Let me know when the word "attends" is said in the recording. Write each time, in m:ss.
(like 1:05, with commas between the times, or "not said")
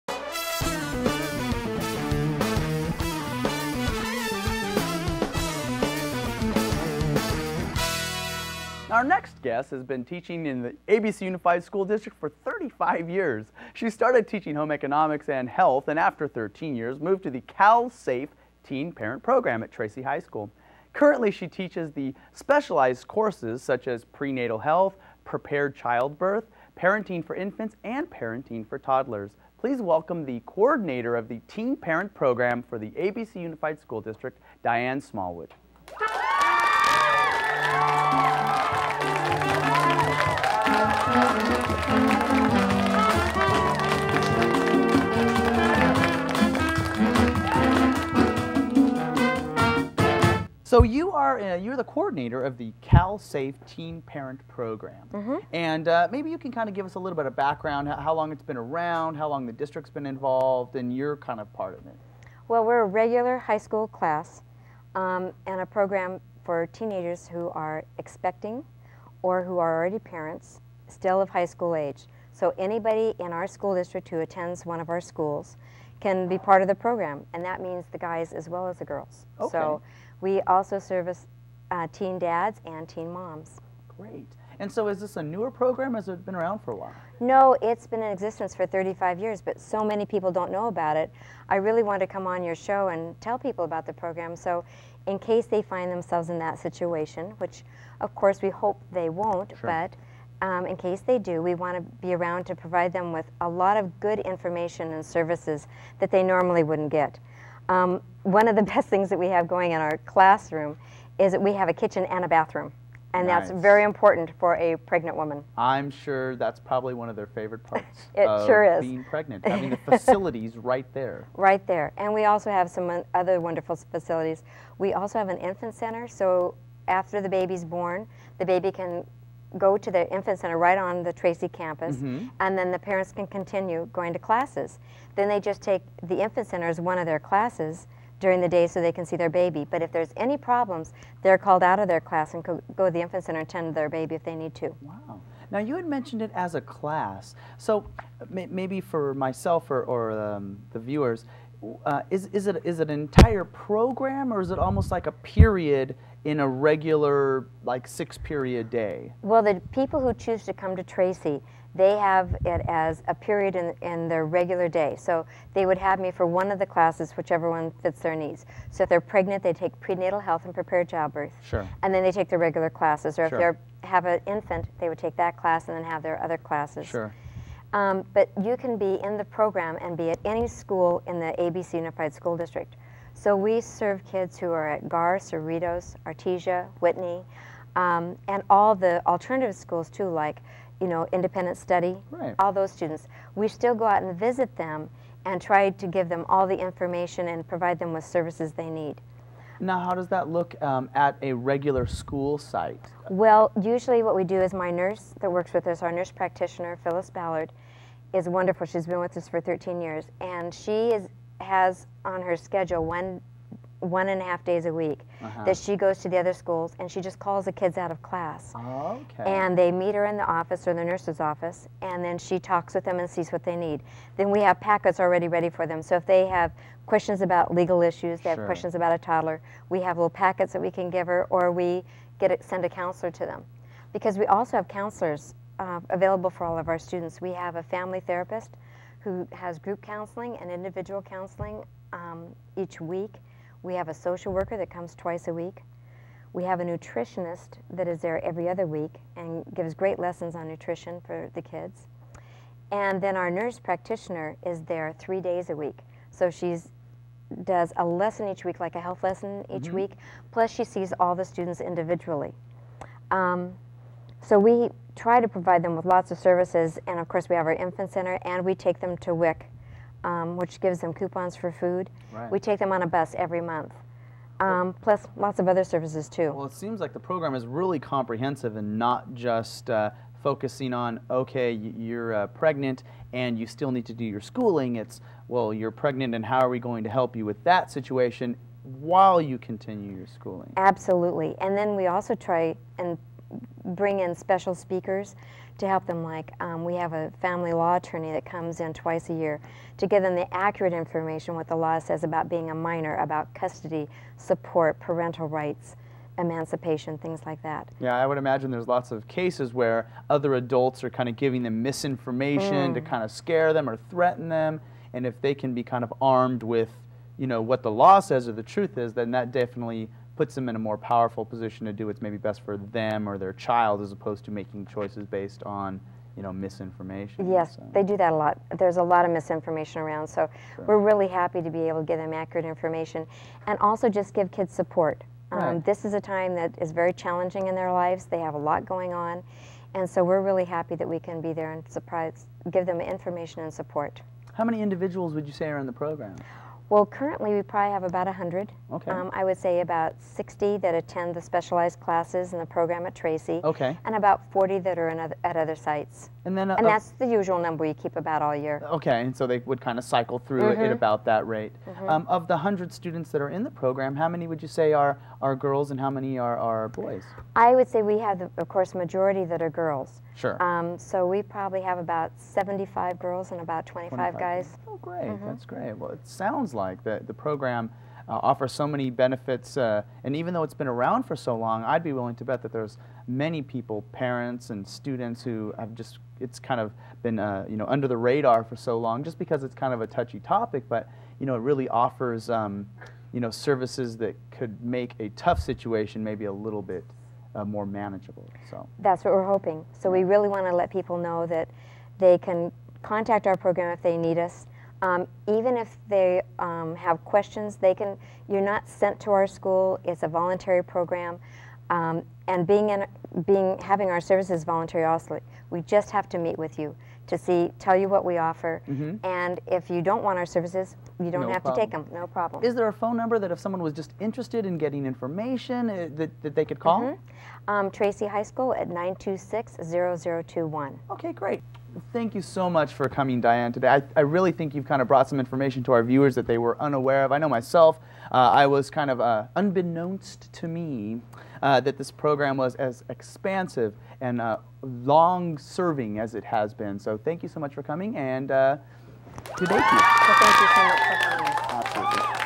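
1:14, 5:50.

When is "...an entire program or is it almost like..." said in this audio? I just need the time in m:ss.
2:32.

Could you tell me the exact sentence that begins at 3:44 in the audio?
Then we have packets already ready for them.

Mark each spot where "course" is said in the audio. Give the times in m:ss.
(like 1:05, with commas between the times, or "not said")
0:23, 1:38, 4:27, 6:08.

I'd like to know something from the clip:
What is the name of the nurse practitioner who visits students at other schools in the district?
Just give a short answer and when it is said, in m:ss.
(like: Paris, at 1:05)
Phyllis Ballard, at 3:26.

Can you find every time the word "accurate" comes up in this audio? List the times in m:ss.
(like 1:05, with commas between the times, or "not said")
5:00, 5:32.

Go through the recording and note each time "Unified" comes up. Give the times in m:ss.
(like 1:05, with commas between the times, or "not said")
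0:11, 0:33, 3:01.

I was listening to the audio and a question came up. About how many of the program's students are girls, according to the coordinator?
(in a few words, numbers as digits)
75.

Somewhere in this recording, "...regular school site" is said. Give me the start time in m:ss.
3:21.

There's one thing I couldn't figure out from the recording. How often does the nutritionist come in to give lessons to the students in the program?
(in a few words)
Every other week.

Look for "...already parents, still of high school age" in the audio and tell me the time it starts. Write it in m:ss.
1:09.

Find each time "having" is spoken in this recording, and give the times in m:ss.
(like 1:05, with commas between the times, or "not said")
1:59, 6:53.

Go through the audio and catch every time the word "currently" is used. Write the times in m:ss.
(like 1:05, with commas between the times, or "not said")
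0:20, 5:46.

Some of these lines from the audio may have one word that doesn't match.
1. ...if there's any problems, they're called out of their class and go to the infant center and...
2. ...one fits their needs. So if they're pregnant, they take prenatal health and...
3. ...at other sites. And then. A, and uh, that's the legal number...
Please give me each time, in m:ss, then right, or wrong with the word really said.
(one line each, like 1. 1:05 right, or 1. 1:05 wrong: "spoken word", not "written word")
1. 2:19 right
2. 2:47 right
3. 5:55 wrong: "usual", not "legal".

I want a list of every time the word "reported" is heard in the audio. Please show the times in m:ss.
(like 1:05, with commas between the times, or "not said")
not said.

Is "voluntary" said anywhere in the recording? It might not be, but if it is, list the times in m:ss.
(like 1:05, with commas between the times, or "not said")
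6:50, 6:54.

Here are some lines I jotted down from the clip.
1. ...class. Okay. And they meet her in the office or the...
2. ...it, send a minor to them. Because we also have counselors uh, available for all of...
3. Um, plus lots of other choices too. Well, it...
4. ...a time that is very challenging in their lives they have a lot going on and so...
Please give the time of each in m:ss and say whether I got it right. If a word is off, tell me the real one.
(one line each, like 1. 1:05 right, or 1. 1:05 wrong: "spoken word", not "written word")
1. 3:38 right
2. 3:52 wrong: "counselor", not "minor"
3. 4:34 wrong: "services", not "choices"
4. 5:35 right.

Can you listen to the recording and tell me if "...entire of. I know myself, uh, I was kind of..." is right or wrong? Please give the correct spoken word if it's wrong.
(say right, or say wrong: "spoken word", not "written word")
wrong: "unaware", not "entire".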